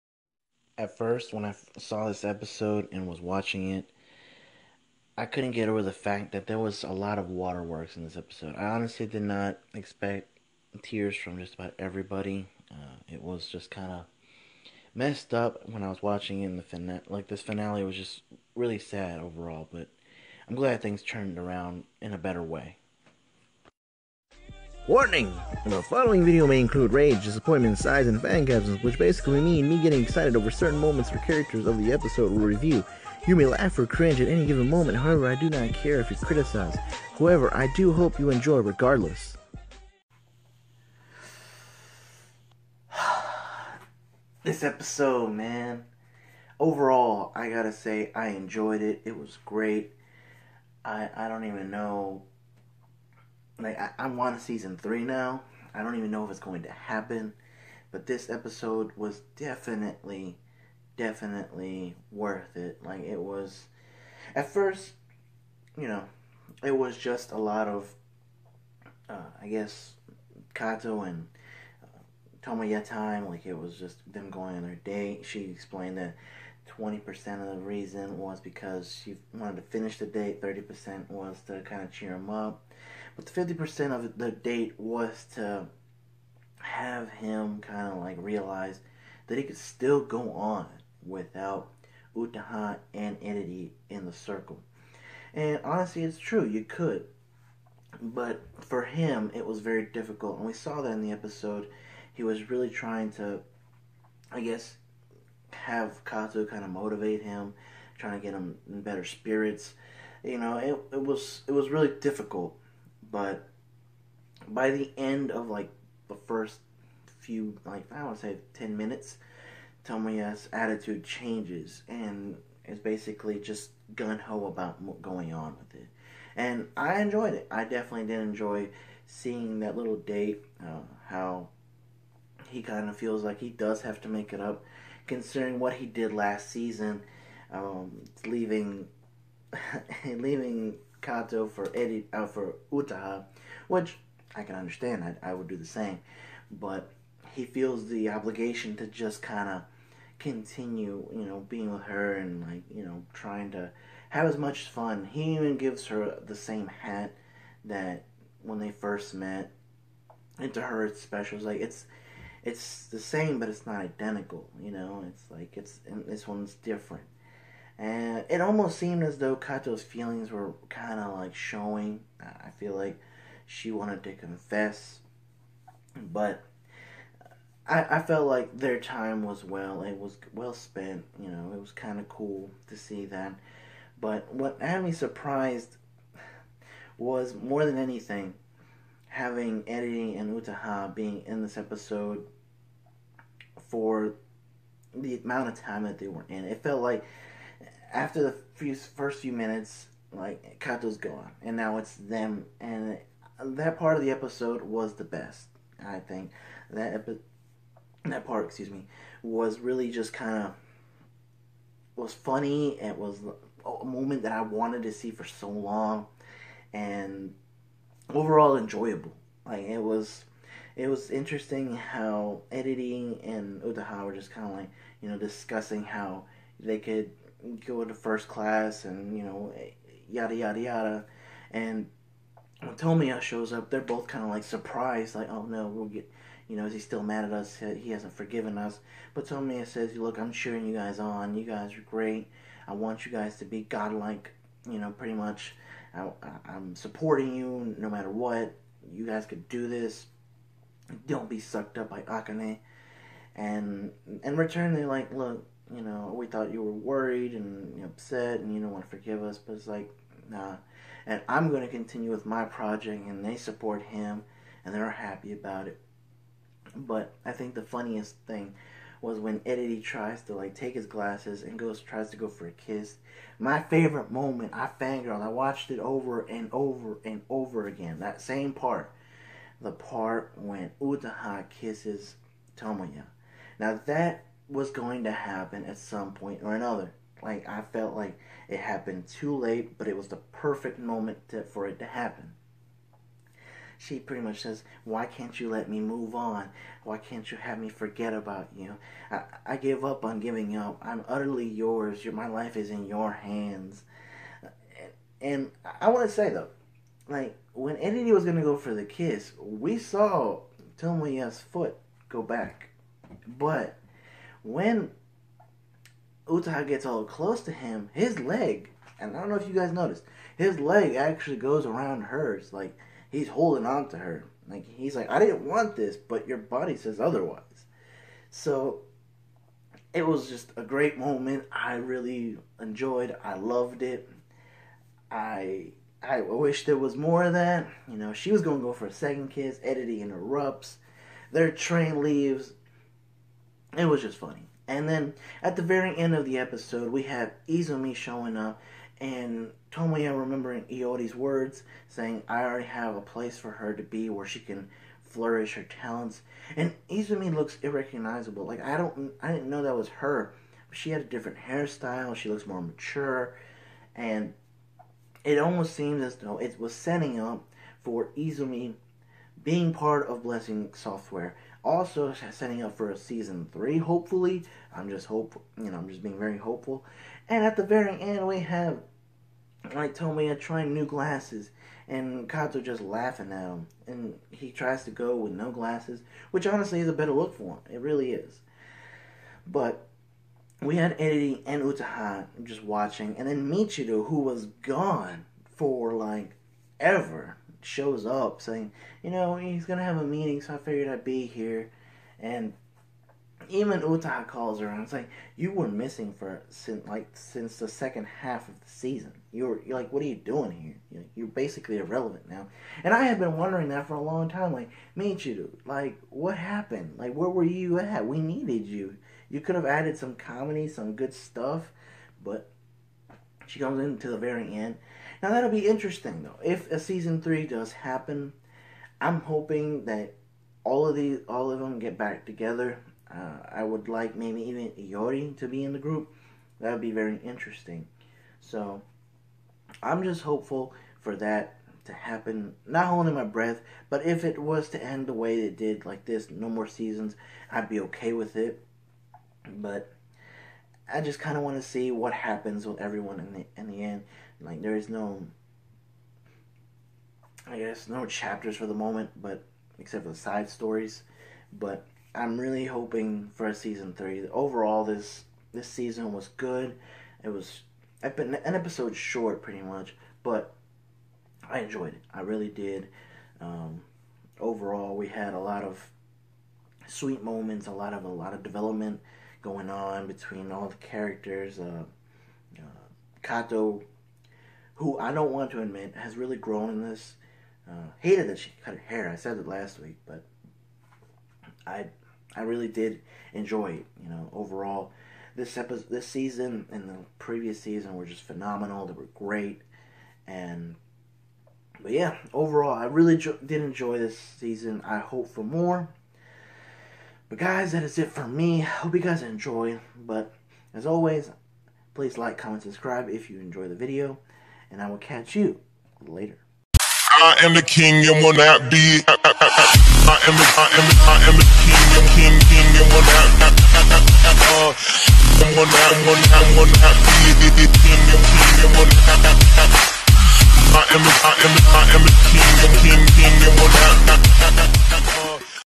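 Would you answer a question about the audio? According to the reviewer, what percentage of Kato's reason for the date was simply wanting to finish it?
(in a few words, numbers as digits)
20%.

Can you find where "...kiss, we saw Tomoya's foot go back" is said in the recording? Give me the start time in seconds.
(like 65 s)
308 s.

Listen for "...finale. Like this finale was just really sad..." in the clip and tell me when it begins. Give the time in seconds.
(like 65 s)
16 s.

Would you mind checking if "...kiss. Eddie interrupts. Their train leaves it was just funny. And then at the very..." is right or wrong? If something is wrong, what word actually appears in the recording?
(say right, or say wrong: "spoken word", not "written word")
right.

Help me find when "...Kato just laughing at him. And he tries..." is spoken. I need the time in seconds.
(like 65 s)
382 s.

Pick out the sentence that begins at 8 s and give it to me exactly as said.
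I honestly did not expect tears from just about everybody.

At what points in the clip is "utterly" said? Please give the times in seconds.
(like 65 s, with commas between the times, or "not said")
301 s.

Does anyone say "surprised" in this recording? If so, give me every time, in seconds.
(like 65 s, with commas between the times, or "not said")
184 s, 234 s.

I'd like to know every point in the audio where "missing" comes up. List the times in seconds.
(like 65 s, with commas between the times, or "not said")
405 s.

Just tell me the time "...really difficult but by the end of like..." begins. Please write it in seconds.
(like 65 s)
111 s.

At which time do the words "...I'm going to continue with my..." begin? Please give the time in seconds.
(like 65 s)
261 s.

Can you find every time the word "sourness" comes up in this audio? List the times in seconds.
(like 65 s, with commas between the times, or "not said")
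not said.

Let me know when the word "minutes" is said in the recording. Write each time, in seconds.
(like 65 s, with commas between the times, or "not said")
118 s, 199 s.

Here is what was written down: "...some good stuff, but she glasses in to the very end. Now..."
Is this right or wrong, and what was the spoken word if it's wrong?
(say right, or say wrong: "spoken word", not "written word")
wrong: "comes", not "glasses".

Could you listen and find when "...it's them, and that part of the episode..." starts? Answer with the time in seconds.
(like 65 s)
201 s.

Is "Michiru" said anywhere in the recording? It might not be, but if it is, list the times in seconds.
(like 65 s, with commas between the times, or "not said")
393 s, 414 s.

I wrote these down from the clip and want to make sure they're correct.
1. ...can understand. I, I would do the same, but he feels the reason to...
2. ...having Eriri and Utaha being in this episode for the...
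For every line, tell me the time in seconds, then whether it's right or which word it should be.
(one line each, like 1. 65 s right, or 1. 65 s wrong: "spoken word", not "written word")
1. 144 s wrong: "obligation", not "reason"
2. 189 s right.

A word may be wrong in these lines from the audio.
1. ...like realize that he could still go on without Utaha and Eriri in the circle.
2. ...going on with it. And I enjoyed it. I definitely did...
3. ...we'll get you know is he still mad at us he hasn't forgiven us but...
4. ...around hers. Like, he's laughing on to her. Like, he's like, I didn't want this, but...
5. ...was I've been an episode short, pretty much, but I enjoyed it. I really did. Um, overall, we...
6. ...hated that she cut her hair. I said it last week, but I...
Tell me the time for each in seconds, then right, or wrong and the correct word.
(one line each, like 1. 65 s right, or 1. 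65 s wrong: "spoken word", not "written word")
1. 87 s right
2. 125 s right
3. 235 s right
4. 321 s wrong: "holding", not "laughing"
5. 467 s right
6. 487 s right.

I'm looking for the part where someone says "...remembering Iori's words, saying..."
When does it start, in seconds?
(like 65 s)
350 s.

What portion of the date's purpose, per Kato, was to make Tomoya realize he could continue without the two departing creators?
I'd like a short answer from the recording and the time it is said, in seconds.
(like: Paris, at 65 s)
50%, at 83 s.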